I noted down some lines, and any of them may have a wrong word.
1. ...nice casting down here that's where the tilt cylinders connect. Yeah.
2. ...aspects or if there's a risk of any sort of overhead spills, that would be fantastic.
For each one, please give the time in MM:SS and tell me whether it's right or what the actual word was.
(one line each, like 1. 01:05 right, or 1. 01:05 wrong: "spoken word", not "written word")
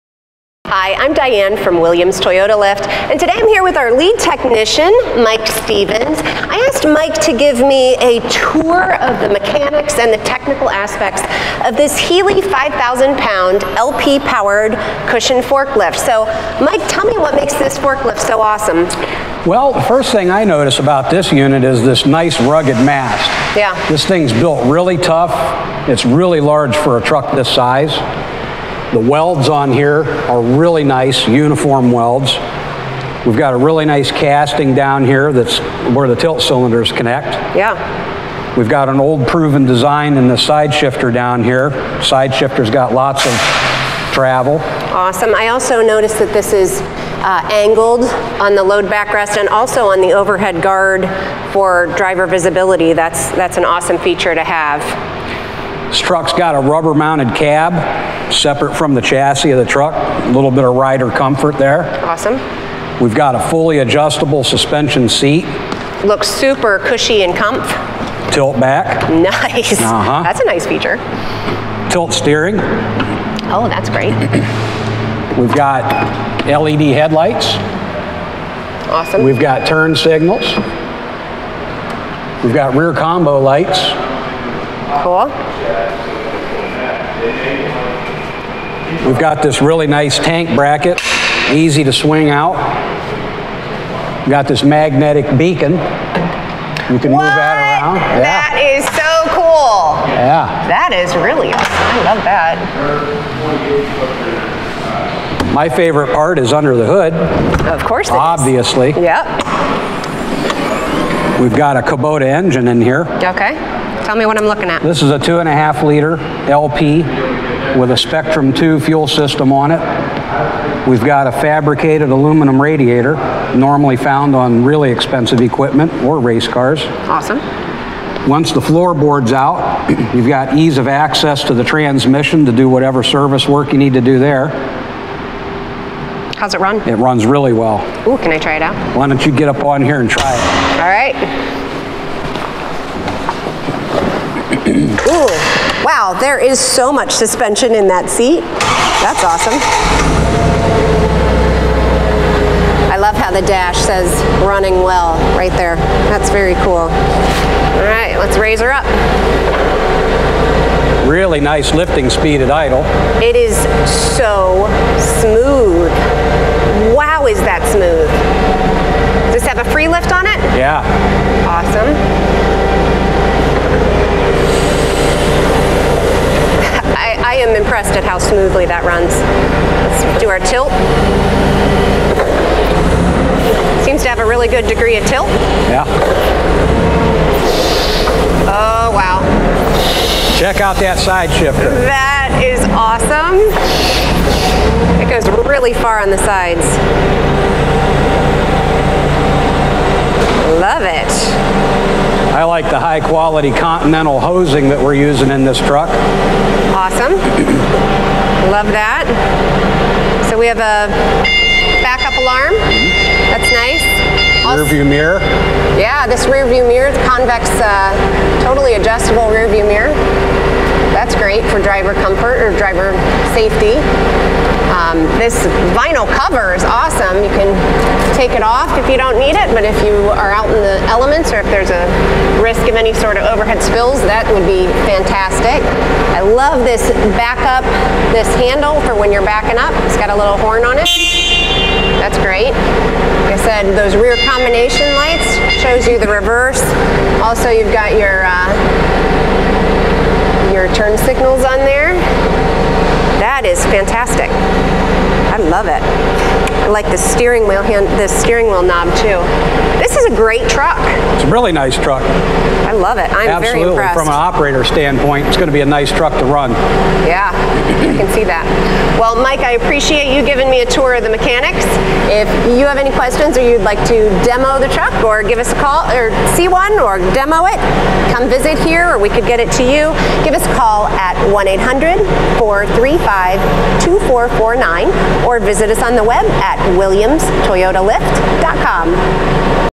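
1. 00:33 right
2. 03:50 wrong: "elements", not "aspects".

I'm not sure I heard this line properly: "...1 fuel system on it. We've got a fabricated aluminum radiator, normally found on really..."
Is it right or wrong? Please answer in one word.
wrong.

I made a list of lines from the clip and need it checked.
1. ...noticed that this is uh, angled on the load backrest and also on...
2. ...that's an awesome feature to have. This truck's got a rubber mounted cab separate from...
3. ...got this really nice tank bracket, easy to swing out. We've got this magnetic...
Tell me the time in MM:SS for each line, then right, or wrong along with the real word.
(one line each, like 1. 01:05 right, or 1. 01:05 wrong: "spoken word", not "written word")
1. 00:45 right
2. 00:53 right
3. 01:29 right.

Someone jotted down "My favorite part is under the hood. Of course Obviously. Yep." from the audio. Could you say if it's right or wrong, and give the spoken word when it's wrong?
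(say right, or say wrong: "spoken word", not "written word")
right.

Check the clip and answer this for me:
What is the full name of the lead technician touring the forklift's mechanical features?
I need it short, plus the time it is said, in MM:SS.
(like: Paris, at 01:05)
Mike Stevens, at 00:05.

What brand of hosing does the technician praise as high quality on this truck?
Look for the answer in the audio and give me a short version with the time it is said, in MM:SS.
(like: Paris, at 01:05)
Continental, at 03:23.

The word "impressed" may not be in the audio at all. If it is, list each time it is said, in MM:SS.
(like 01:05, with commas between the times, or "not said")
02:57, 04:23.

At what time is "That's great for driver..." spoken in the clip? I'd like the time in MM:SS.
03:40.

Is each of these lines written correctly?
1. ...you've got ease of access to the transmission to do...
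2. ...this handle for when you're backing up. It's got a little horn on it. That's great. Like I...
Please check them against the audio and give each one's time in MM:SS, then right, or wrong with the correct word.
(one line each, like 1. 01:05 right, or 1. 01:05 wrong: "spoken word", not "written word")
1. 02:10 right
2. 03:58 right.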